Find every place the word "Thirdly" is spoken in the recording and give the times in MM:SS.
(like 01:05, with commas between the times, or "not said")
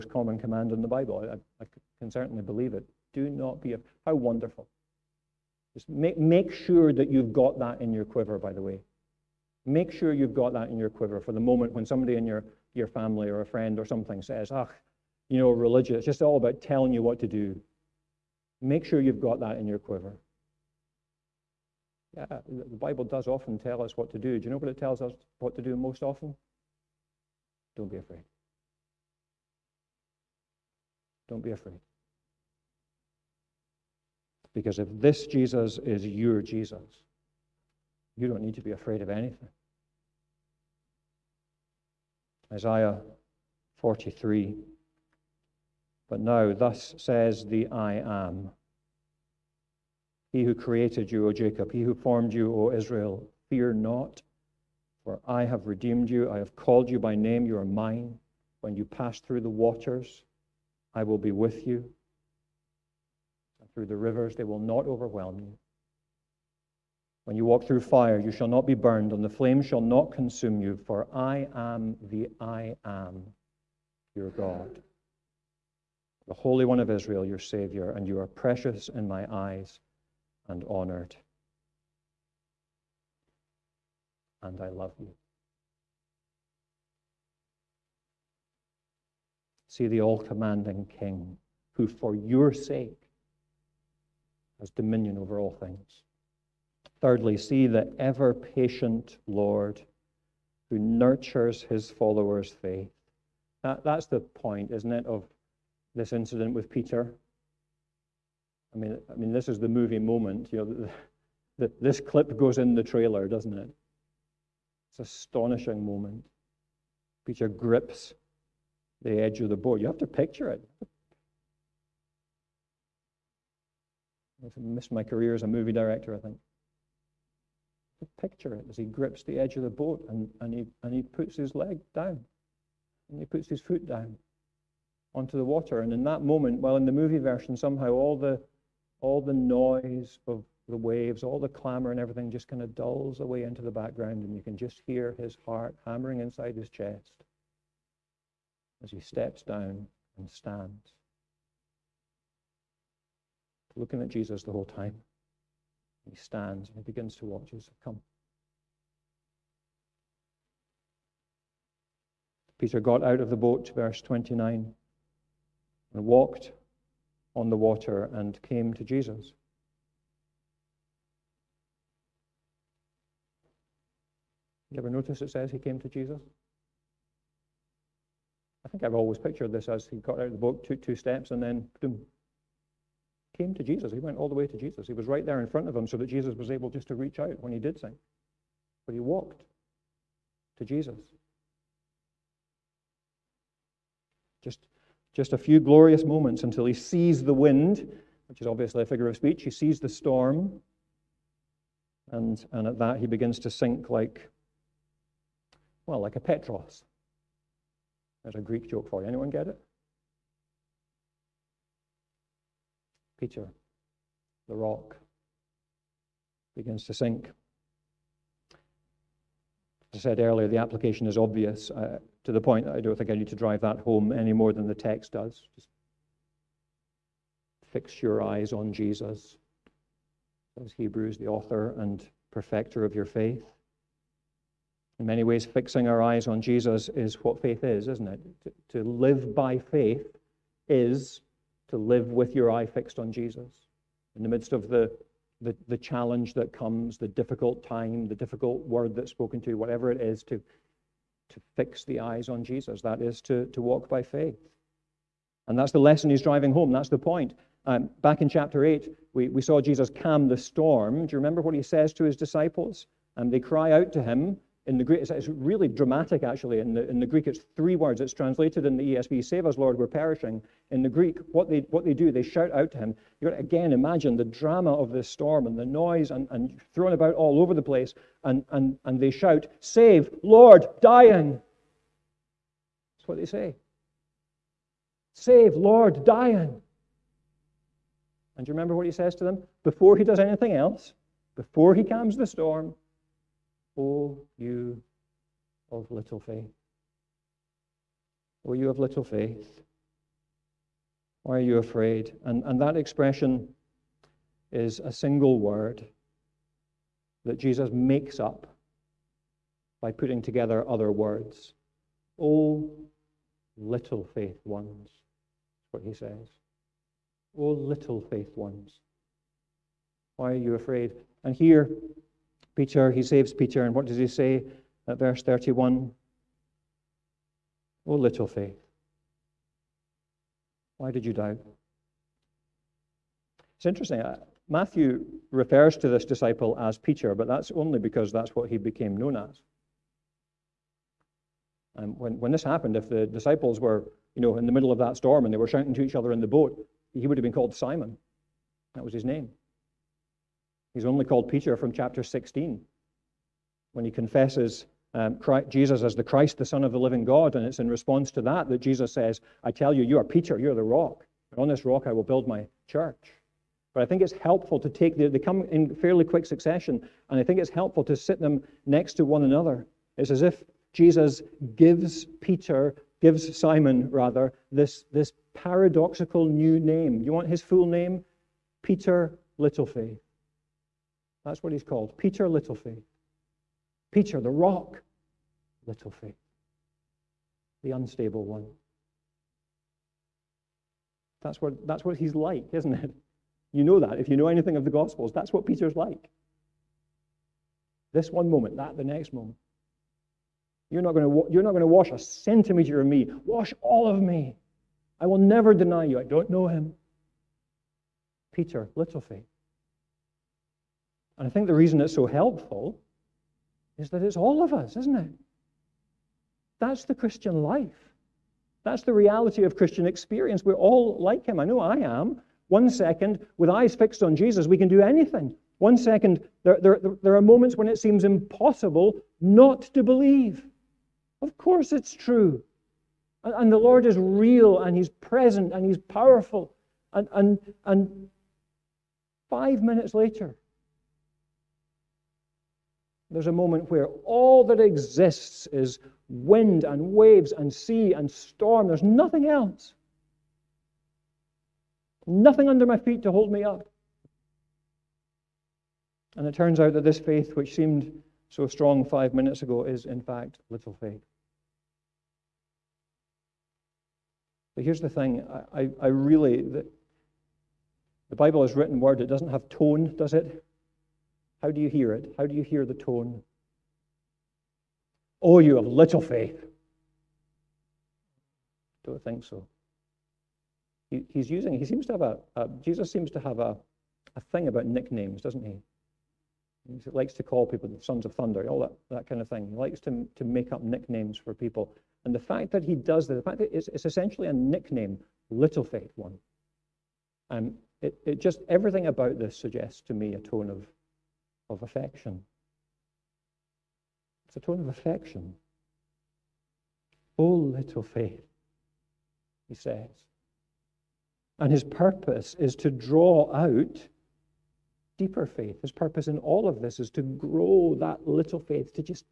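01:36.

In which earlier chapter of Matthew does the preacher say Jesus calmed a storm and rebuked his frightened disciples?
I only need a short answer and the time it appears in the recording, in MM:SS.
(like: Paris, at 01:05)
Chapter 8, at 04:18.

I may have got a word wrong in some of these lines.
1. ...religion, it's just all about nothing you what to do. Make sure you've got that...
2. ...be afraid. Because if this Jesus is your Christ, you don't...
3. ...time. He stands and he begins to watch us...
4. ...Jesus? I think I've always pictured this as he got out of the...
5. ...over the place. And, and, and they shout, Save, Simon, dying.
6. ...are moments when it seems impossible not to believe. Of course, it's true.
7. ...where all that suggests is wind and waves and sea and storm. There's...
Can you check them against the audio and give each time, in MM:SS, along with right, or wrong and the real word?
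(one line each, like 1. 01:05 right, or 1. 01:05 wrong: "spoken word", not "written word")
1. 00:15 wrong: "telling", not "nothing"
2. 00:31 wrong: "Jesus", not "Christ"
3. 02:34 right
4. 02:55 right
5. 04:37 wrong: "Lord", not "Simon"
6. 07:07 right
7. 07:23 wrong: "exists", not "suggests".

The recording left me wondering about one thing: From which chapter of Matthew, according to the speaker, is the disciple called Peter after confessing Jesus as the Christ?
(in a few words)
Chapter 16.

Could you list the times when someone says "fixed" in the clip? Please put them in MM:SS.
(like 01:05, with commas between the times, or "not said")
04:02, 07:03.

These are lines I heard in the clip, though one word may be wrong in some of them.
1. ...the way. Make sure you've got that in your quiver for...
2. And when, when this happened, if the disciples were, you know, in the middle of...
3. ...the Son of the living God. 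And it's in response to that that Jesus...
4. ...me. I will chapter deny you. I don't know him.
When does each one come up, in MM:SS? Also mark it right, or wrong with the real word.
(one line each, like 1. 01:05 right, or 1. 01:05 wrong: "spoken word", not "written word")
1. 00:08 right
2. 05:41 right
3. 05:56 right
4. 06:43 wrong: "never", not "chapter".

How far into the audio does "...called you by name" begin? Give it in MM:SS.
00:56.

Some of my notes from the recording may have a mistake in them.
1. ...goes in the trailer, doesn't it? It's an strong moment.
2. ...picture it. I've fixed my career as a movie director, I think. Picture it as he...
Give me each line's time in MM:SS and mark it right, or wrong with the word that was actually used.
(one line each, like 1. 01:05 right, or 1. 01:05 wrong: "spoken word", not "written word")
1. 01:52 wrong: "astonishing", not "strong"
2. 02:00 wrong: "missed", not "fixed".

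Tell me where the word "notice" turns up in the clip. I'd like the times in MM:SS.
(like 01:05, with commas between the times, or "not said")
02:54.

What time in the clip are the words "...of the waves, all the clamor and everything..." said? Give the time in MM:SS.
02:20.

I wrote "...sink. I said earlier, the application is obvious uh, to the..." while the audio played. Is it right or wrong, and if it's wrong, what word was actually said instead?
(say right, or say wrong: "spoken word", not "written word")
right.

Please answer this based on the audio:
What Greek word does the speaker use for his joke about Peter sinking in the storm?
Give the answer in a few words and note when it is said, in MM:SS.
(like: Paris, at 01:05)
Petros, at 03:26.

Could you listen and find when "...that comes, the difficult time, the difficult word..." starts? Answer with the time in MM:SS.
04:06.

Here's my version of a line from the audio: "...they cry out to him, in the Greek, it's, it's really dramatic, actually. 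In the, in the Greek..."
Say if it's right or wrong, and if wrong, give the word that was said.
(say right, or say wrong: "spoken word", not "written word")
right.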